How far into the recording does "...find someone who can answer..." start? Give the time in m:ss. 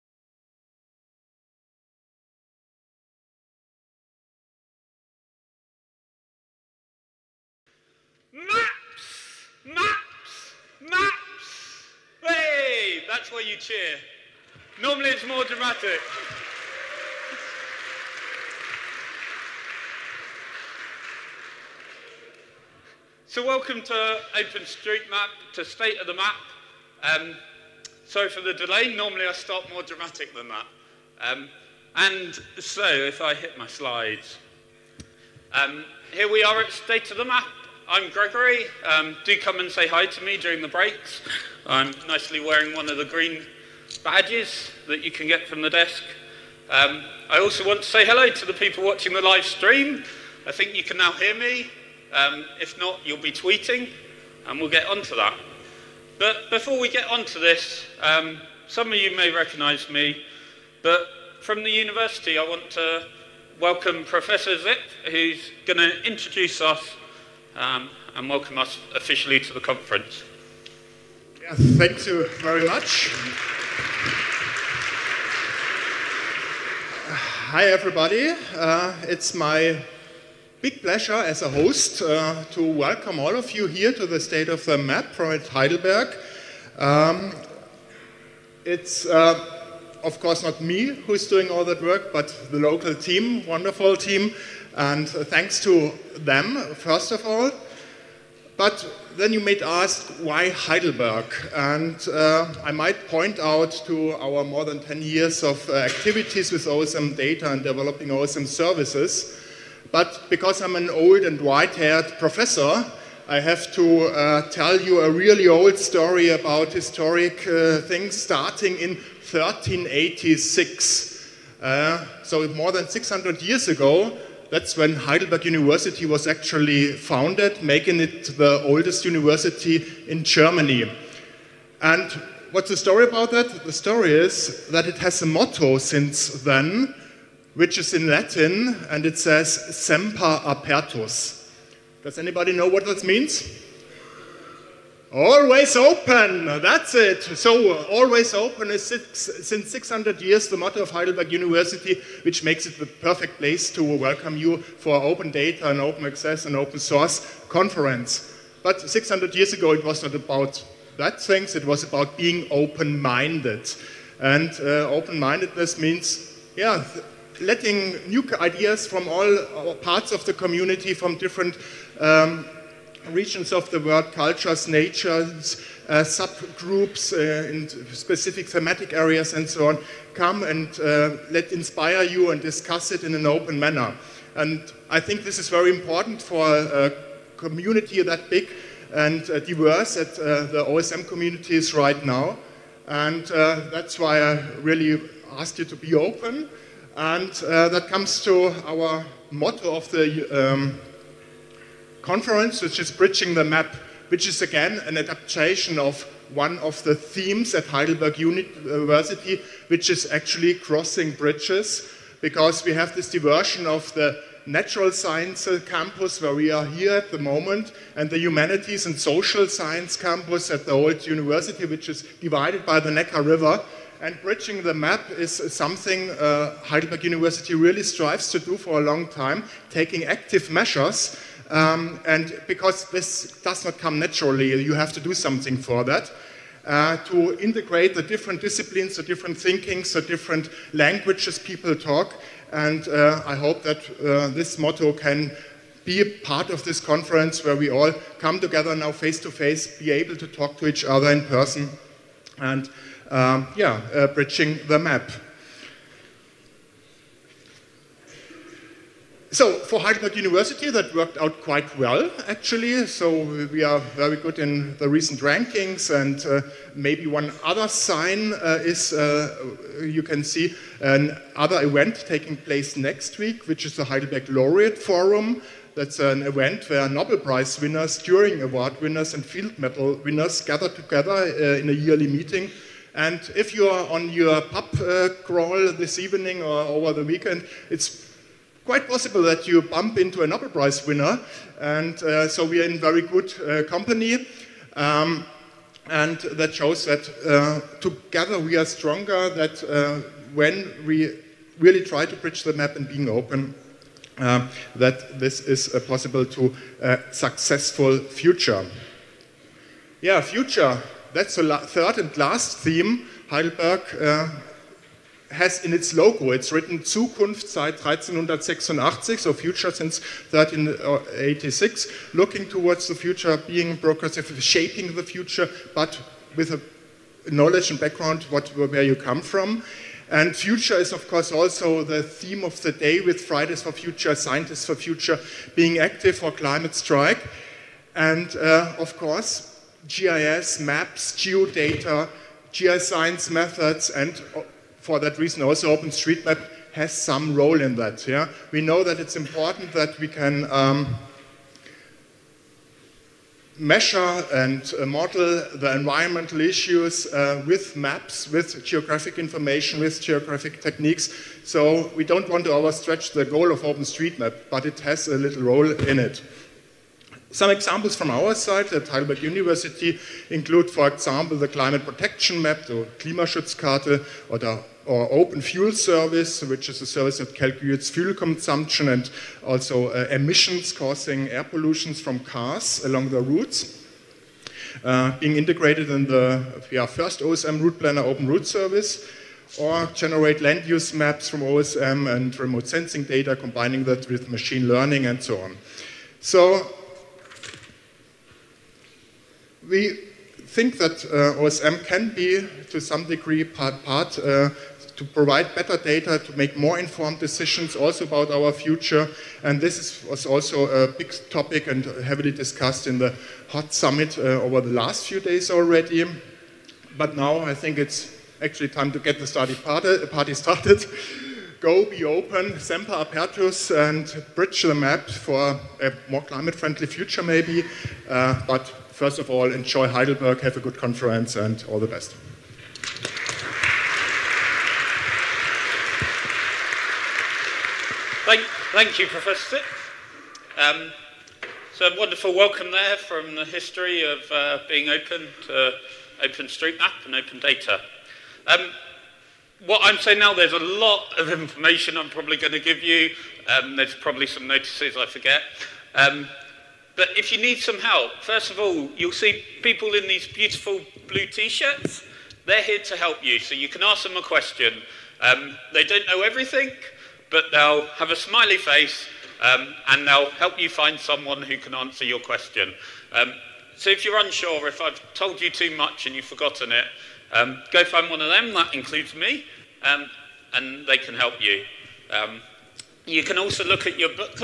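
7:50.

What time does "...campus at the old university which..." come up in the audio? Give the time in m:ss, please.
3:39.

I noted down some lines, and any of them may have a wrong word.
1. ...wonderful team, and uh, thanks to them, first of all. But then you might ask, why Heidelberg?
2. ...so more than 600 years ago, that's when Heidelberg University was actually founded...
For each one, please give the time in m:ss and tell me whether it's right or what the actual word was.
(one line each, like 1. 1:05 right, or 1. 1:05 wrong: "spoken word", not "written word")
1. 1:33 right
2. 2:02 right.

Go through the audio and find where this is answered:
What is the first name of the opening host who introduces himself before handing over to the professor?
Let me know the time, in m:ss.
0:38.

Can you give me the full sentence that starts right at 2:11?
And what's the story about that?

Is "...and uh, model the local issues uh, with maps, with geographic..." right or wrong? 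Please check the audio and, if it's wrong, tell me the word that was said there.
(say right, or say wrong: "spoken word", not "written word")
wrong: "environmental", not "local".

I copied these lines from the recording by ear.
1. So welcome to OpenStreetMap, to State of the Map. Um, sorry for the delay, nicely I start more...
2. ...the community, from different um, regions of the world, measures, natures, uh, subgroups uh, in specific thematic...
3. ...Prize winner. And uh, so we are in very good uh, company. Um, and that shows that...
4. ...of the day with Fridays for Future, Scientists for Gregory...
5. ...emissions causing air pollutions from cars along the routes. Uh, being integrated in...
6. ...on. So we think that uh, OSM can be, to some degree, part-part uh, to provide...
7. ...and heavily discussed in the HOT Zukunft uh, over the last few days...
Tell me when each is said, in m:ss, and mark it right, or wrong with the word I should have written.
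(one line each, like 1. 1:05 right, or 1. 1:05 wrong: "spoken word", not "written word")
1. 0:23 wrong: "normally", not "nicely"
2. 2:50 wrong: "cultures", not "measures"
3. 4:50 right
4. 5:32 wrong: "Future", not "Gregory"
5. 6:20 right
6. 6:35 right
7. 6:51 wrong: "Summit", not "Zukunft".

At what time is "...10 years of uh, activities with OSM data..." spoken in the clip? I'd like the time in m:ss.
1:44.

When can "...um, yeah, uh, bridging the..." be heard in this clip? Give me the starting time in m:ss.
4:13.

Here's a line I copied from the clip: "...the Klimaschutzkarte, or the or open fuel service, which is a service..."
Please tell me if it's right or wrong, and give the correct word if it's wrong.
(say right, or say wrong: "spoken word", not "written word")
right.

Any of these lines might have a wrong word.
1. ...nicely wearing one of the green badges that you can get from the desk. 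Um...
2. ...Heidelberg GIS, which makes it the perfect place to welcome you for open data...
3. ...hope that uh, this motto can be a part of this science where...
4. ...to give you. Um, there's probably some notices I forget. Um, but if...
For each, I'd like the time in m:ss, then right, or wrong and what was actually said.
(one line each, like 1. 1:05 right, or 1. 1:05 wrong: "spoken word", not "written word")
1. 0:42 right
2. 2:30 wrong: "University", not "GIS"
3. 4:03 wrong: "conference", not "science"
4. 7:32 right.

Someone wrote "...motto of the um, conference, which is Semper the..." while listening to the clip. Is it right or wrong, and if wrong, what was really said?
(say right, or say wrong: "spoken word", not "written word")
wrong: "Bridging", not "Semper".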